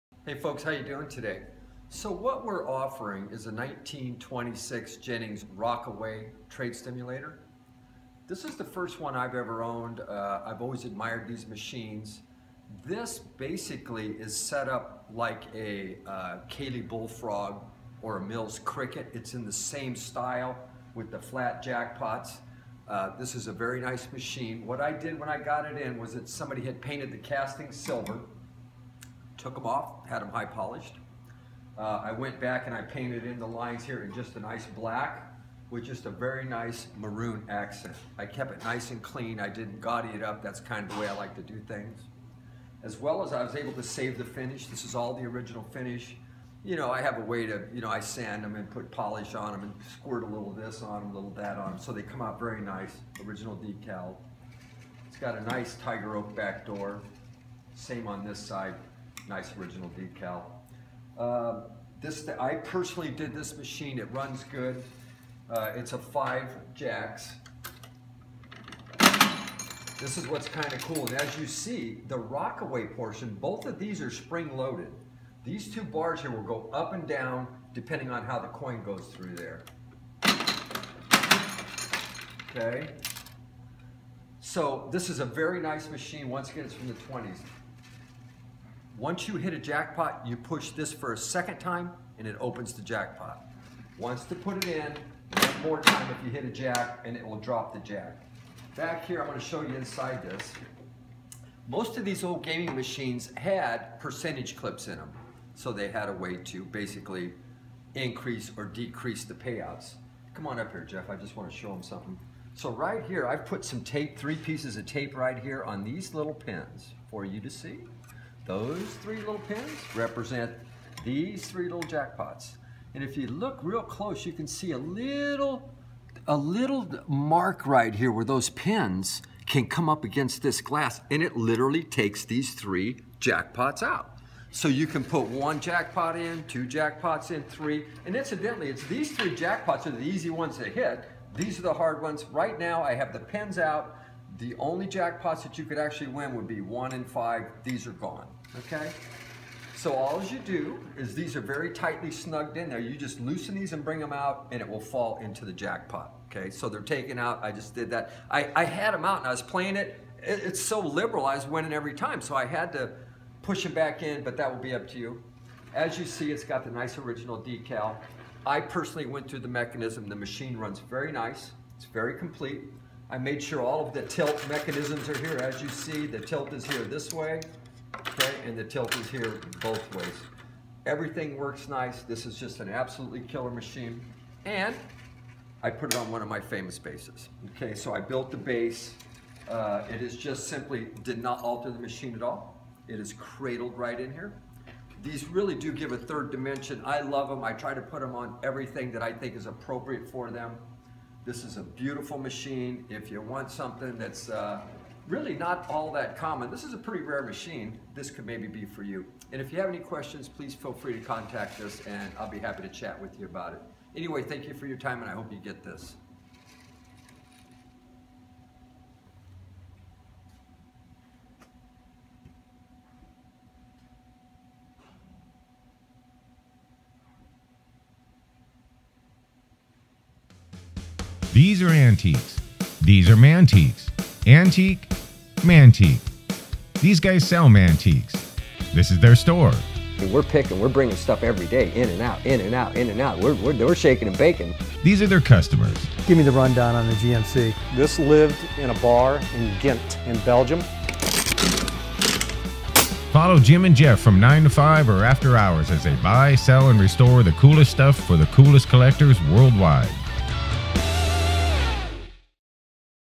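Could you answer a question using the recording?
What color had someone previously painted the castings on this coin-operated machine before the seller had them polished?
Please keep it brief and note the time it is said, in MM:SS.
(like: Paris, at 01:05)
Silver, at 00:27.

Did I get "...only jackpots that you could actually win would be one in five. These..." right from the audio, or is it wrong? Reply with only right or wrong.
right.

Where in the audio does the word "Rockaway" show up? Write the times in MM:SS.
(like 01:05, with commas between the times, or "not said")
00:05, 01:12.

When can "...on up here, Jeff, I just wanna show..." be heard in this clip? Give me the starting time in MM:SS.
01:50.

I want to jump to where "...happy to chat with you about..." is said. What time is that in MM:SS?
03:32.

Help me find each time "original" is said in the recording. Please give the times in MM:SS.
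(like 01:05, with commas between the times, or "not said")
00:45, 00:53, 00:59, 02:46.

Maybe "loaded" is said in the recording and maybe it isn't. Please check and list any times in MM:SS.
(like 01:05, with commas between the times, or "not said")
01:14.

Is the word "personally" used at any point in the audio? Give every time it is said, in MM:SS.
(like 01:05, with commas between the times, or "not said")
01:02, 02:48.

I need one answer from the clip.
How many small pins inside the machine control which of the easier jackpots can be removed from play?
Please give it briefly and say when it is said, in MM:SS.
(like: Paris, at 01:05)
3, at 01:59.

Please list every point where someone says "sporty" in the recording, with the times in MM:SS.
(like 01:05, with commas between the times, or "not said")
not said.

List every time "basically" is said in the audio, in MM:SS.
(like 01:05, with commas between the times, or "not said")
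00:13, 01:46.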